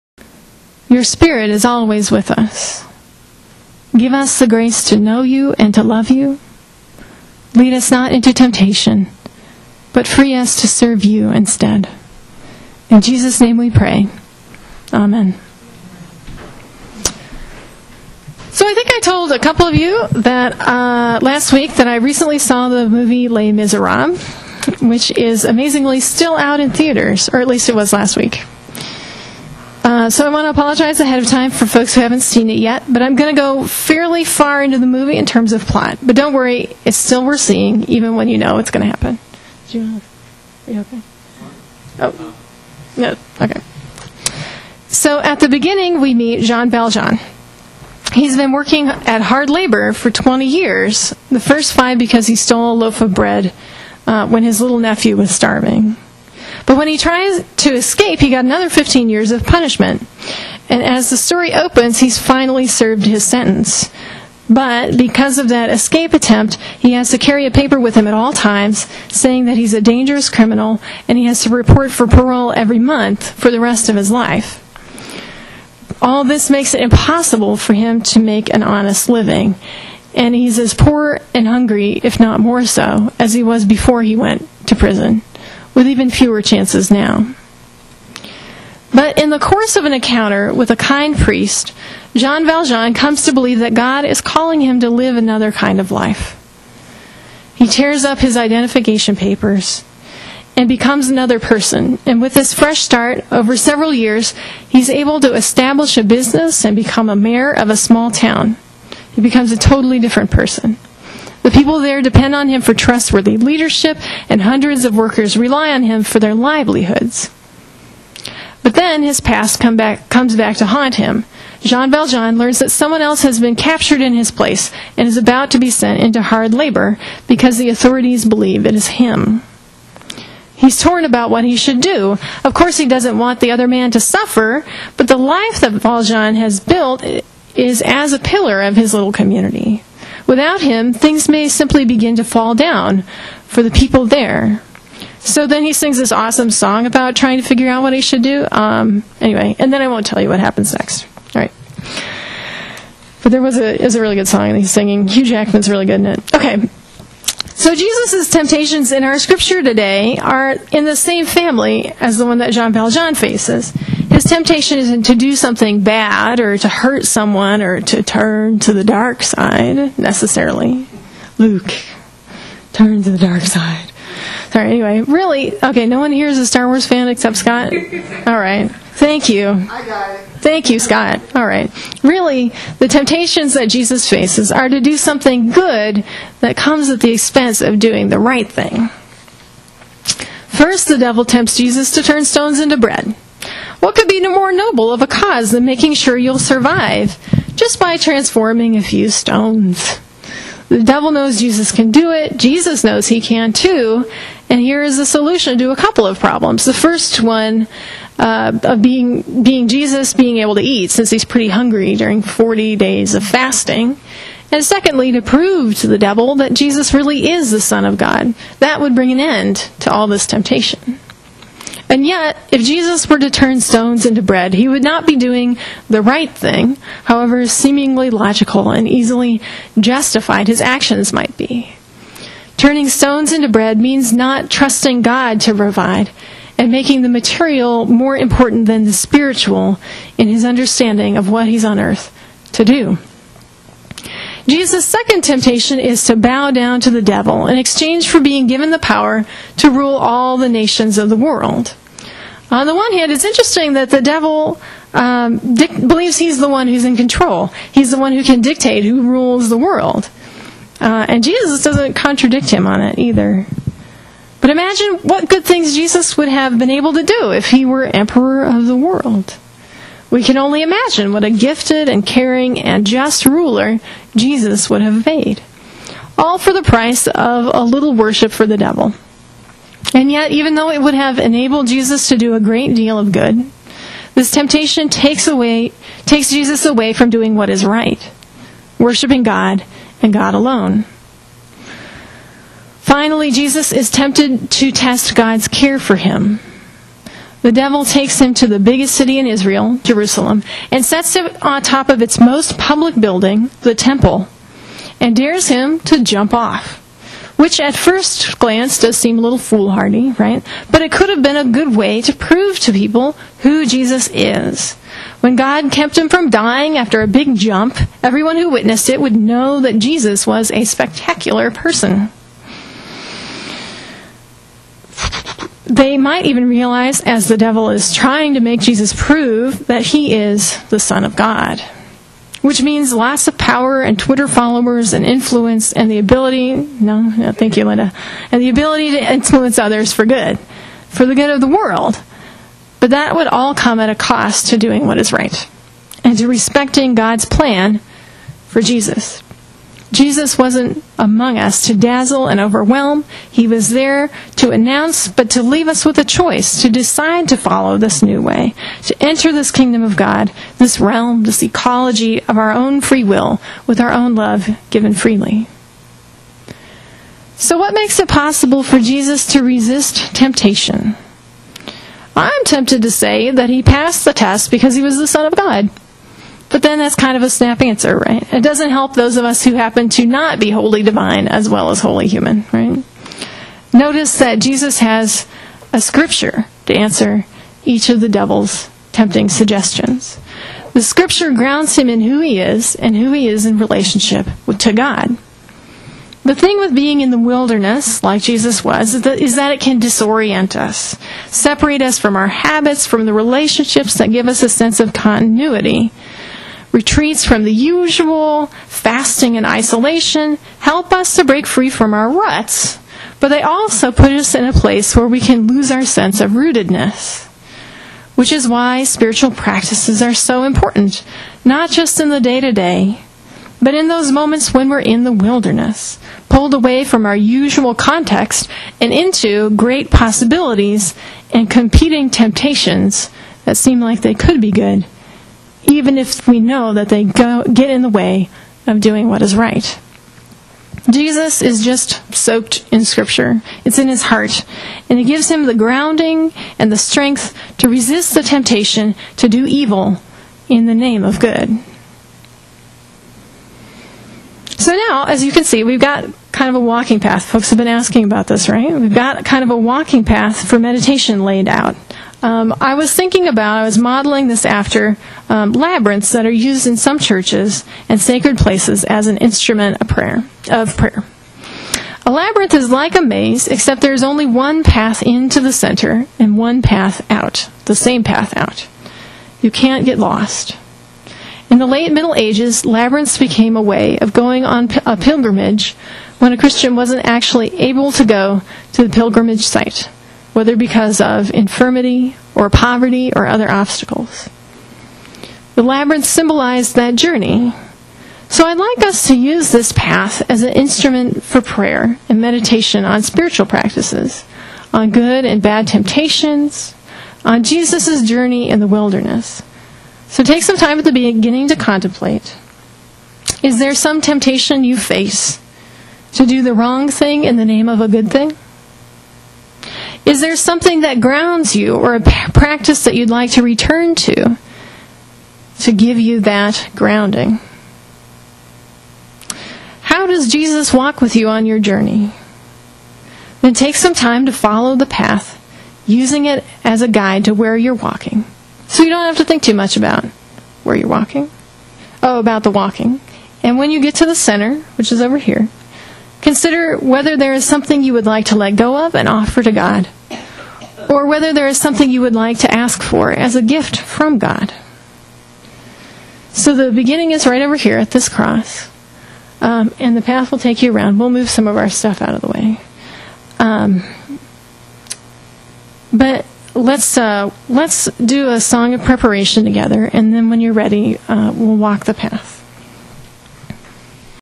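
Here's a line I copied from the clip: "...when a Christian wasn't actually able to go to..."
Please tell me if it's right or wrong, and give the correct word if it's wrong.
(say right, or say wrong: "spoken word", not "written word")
right.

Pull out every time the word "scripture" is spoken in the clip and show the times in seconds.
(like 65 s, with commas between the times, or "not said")
159 s, 385 s, 390 s, 442 s.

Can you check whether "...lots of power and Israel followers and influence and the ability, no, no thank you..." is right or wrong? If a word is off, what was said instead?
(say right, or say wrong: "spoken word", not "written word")
wrong: "Twitter", not "Israel".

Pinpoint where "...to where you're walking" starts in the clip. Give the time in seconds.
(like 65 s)
537 s.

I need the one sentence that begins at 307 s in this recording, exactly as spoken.
Which at first glance does seem a little foolhardy, right?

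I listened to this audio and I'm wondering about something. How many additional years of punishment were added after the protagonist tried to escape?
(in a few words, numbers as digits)
15.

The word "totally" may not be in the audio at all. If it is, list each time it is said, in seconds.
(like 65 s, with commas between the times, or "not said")
109 s.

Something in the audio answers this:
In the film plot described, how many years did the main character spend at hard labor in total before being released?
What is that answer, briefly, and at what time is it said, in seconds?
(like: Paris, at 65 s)
20, at 50 s.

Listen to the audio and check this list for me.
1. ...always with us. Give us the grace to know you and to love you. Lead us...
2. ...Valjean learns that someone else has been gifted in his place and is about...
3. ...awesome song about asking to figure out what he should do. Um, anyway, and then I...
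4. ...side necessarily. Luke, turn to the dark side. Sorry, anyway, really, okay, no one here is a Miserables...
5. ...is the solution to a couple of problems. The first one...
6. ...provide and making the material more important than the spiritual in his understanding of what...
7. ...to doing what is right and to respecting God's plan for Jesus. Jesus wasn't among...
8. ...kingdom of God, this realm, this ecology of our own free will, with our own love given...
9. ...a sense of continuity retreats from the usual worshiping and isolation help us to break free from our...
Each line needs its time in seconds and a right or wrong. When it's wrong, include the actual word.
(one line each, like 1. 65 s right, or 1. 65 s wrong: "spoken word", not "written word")
1. 1 s right
2. 121 s wrong: "captured", not "gifted"
3. 146 s wrong: "trying", not "asking"
4. 169 s wrong: "Star", not "Miserables"
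5. 204 s right
6. 235 s right
7. 344 s right
8. 359 s right
9. 404 s wrong: "fasting", not "worshiping".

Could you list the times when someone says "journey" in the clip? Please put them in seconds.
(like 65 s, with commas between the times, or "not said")
496 s, 508 s, 531 s.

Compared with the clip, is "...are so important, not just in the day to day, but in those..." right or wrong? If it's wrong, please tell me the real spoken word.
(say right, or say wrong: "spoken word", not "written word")
right.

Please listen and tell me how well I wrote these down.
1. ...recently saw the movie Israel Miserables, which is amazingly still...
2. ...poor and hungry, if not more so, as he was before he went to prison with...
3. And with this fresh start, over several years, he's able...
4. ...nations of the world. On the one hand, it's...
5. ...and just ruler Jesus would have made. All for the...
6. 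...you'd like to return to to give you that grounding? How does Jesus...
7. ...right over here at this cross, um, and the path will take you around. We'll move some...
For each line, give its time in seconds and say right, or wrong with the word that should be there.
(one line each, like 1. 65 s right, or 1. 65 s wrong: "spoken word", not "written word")
1. 21 s wrong: "Les", not "Israel"
2. 80 s right
3. 102 s right
4. 250 s right
5. 272 s right
6. 522 s right
7. 557 s right.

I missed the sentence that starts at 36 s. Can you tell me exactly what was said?
But don't worry, it's still worth seeing, even when you know it's going to happen.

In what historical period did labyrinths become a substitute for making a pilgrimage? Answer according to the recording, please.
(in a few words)
The late Middle Ages.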